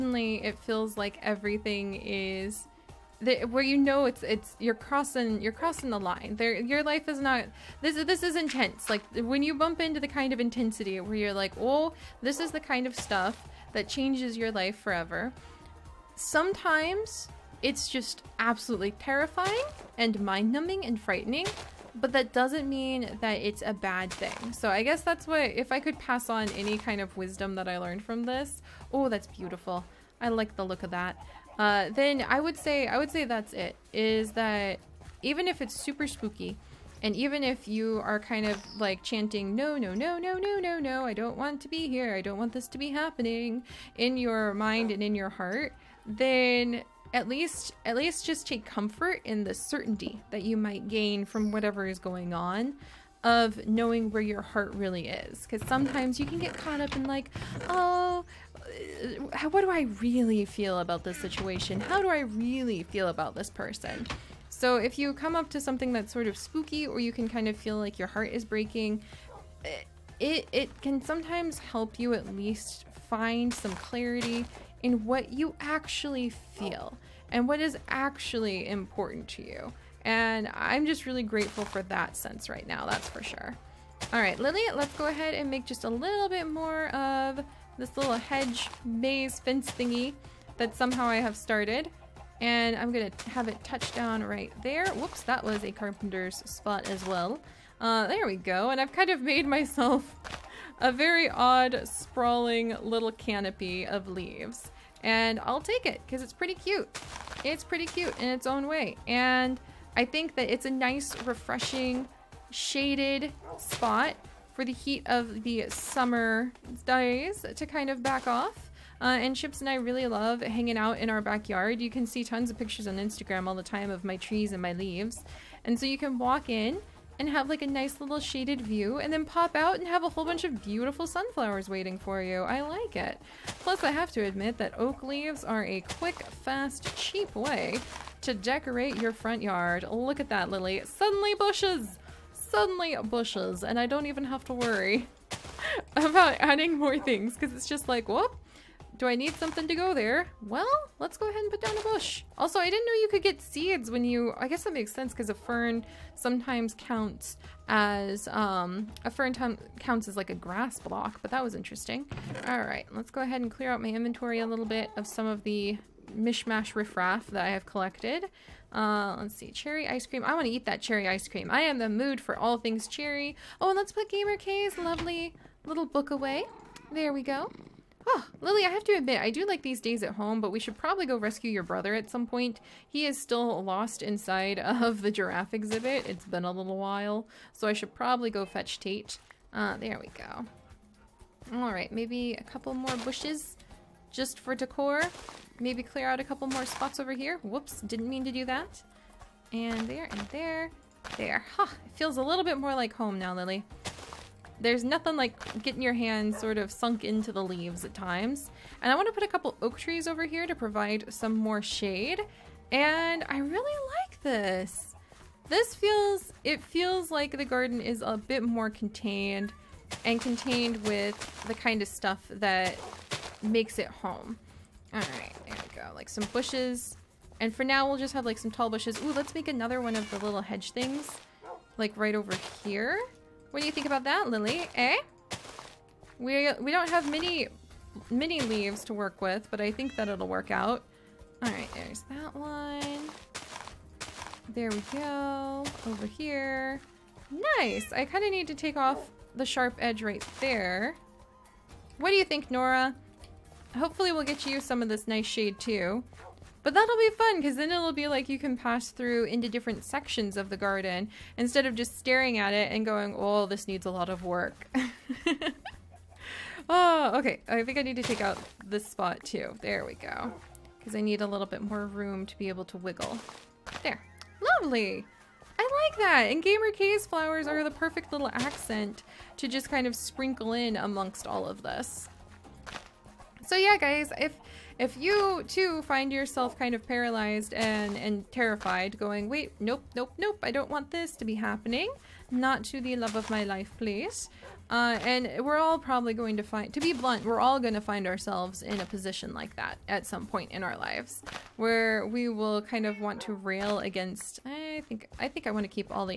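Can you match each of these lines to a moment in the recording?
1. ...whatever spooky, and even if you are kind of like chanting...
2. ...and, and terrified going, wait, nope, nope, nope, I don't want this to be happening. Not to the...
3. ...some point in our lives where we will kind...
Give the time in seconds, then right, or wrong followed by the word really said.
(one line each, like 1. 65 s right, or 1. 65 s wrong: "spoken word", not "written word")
1. 35 s wrong: "super", not "whatever"
2. 287 s right
3. 300 s right.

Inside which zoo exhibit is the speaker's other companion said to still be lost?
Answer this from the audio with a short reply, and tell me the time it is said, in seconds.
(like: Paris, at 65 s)
Giraffe exhibit, at 185 s.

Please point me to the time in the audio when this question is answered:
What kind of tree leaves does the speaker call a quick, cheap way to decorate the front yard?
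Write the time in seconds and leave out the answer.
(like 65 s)
134 s.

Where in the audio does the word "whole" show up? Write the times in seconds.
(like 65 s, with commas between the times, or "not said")
130 s.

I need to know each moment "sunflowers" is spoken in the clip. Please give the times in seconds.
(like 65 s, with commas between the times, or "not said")
131 s.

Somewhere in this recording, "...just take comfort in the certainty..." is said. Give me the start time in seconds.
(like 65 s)
48 s.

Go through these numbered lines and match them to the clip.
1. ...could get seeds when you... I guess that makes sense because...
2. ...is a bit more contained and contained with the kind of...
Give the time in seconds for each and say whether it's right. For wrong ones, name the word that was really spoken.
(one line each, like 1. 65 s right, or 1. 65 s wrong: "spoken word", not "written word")
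1. 153 s right
2. 217 s right.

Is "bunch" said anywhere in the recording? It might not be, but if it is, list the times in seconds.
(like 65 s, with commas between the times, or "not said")
130 s.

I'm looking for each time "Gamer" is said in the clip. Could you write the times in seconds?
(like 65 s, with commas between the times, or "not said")
174 s, 276 s.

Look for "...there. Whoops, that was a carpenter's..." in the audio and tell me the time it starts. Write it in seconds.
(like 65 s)
94 s.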